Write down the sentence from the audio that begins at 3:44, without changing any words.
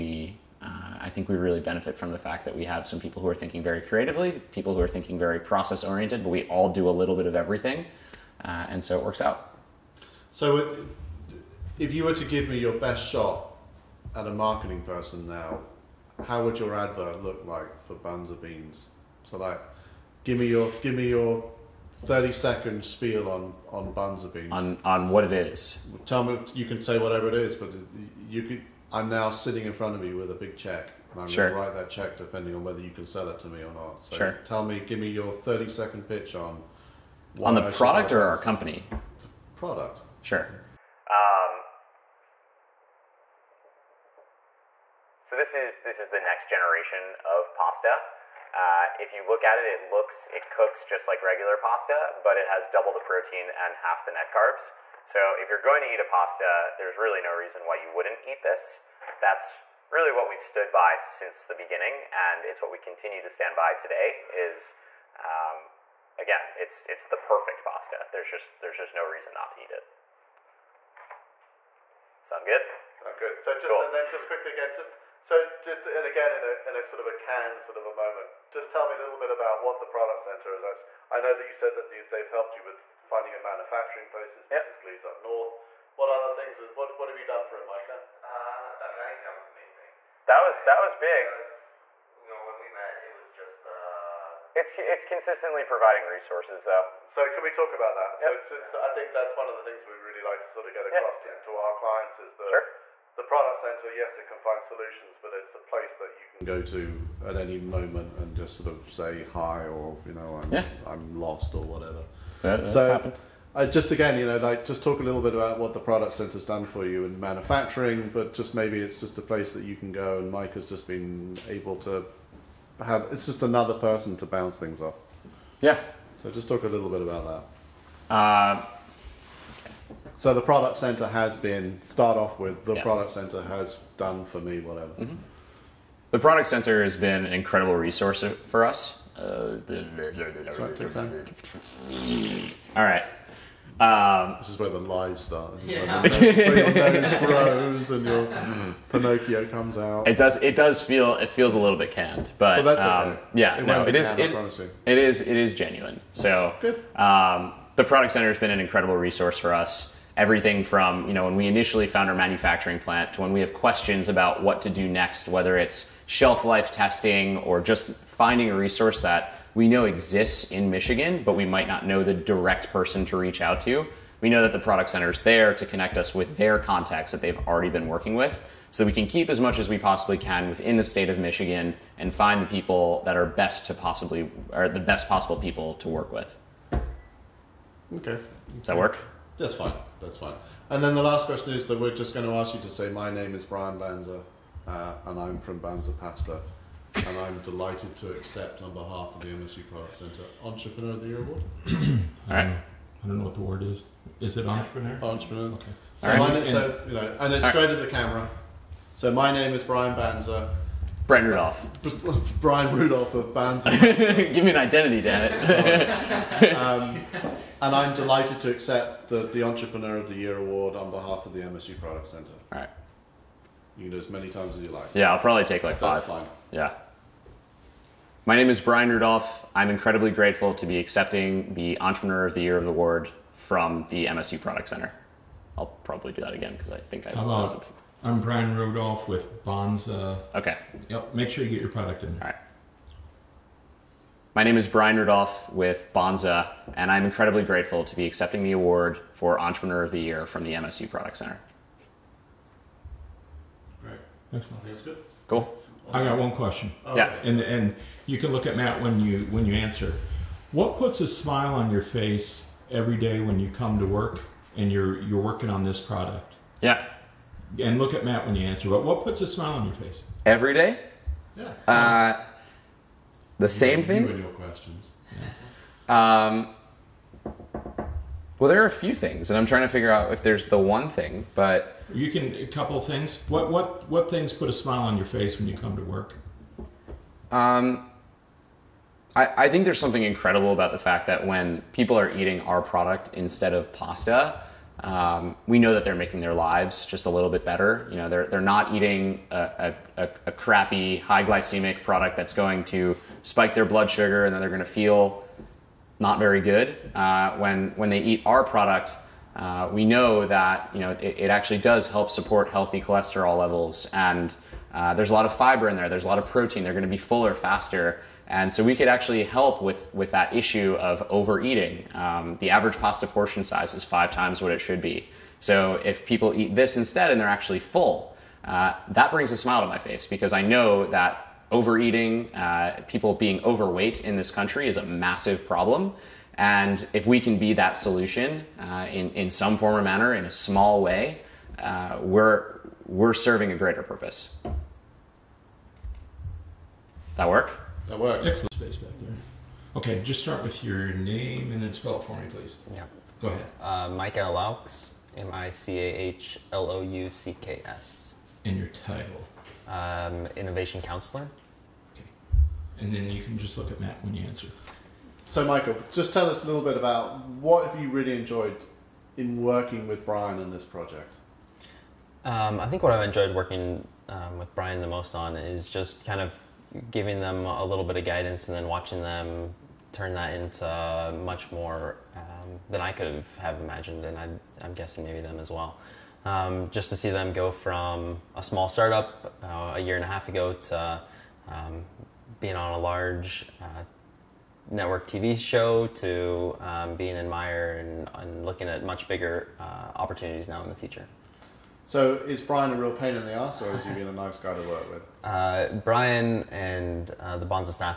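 Yeah, I'll probably take like That's five.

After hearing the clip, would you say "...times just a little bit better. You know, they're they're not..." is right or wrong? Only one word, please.
wrong.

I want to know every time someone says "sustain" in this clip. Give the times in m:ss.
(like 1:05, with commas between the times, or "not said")
not said.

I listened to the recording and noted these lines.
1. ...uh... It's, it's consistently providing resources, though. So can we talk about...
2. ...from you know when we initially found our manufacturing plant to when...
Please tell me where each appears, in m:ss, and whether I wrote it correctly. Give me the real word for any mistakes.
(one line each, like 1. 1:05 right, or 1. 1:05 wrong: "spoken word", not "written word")
1. 1:33 right
2. 2:40 right.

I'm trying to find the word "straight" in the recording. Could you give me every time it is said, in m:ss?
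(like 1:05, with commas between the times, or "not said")
3:27.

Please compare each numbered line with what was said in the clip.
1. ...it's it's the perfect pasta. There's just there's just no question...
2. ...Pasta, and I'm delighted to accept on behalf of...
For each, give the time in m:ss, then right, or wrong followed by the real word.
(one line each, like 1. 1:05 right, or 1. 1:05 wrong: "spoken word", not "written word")
1. 1:06 wrong: "reason", not "question"
2. 3:15 right.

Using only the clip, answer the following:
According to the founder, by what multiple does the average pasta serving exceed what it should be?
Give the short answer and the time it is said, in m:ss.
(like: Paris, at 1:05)
5 times, at 5:23.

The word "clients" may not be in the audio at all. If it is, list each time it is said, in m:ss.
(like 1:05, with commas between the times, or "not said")
1:41.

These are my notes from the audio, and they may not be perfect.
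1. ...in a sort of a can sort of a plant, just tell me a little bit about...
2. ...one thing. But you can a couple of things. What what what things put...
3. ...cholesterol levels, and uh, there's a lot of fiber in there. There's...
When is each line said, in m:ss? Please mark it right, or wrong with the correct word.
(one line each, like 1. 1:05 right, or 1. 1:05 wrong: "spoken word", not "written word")
1. 1:16 wrong: "moment", not "plant"
2. 4:40 right
3. 5:12 right.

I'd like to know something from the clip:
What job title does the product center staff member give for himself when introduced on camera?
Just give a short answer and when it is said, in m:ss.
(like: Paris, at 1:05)
Innovation Counselor, at 6:00.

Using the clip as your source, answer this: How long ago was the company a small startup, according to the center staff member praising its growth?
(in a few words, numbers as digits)
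a year and a half.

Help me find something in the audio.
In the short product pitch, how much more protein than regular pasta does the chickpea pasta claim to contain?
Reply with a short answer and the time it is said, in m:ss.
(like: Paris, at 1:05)
double, at 0:52.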